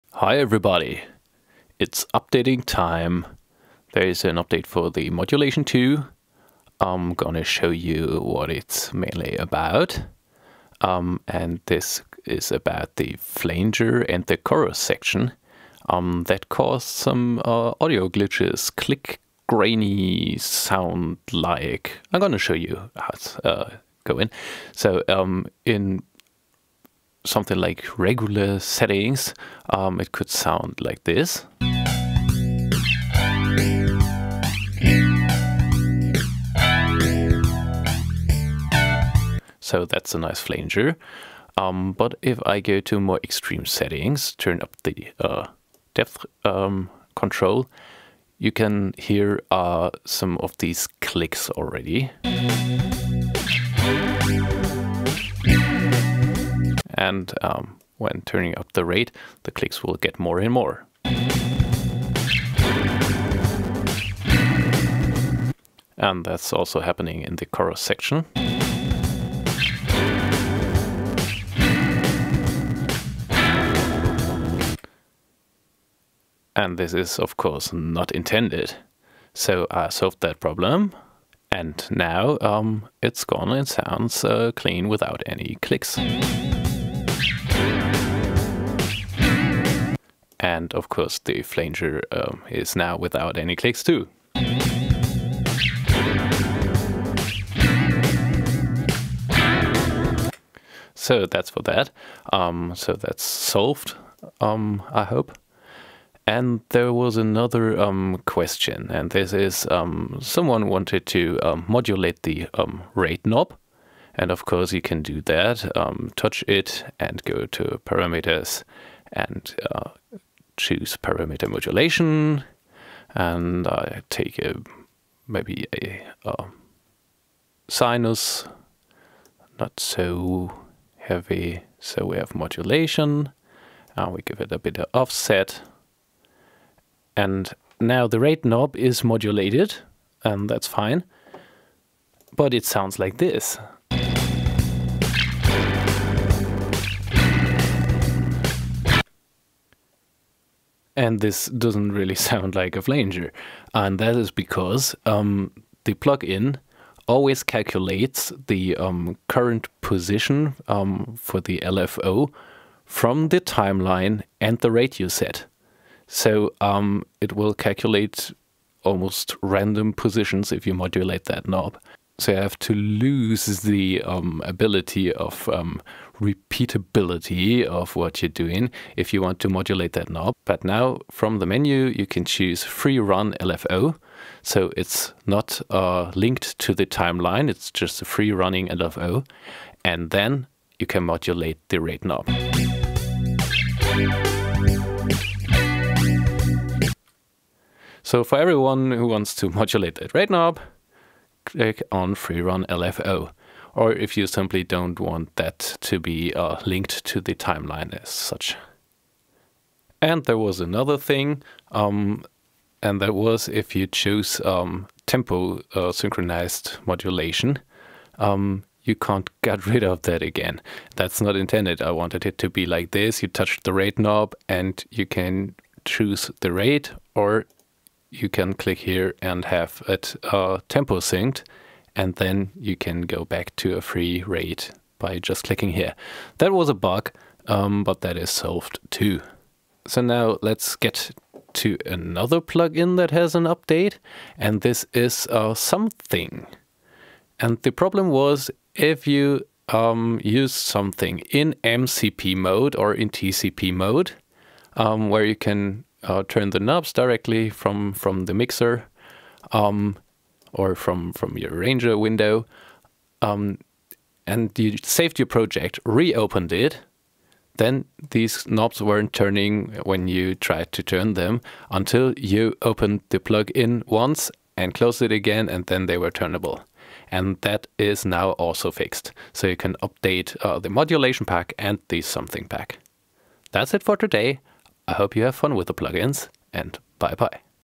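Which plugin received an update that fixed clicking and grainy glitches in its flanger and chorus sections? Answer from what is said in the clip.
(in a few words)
Modulation 2.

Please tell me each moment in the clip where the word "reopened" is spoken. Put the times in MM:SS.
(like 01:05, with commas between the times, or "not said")
04:25.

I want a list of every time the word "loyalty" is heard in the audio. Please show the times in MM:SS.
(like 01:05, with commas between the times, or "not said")
not said.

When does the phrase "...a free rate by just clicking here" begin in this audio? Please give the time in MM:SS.
03:53.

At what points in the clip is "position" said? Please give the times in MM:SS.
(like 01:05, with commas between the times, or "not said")
02:39, 02:49.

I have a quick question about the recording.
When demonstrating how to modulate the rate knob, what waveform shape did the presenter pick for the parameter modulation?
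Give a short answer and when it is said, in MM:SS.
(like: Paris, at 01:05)
sinus, at 02:07.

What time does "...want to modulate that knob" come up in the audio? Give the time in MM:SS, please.
02:59.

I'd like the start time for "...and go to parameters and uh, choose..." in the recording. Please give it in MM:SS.
01:56.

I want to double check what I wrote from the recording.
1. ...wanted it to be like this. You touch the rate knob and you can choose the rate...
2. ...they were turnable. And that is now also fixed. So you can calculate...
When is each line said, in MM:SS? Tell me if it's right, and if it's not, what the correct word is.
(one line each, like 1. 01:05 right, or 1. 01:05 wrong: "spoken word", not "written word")
1. 03:41 right
2. 04:35 wrong: "update", not "calculate".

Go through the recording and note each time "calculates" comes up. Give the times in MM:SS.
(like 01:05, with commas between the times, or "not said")
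02:37, 02:47.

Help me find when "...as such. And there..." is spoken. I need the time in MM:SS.
03:28.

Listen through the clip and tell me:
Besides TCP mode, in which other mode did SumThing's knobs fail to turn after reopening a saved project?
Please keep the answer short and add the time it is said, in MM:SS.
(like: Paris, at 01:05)
MCP mode, at 04:11.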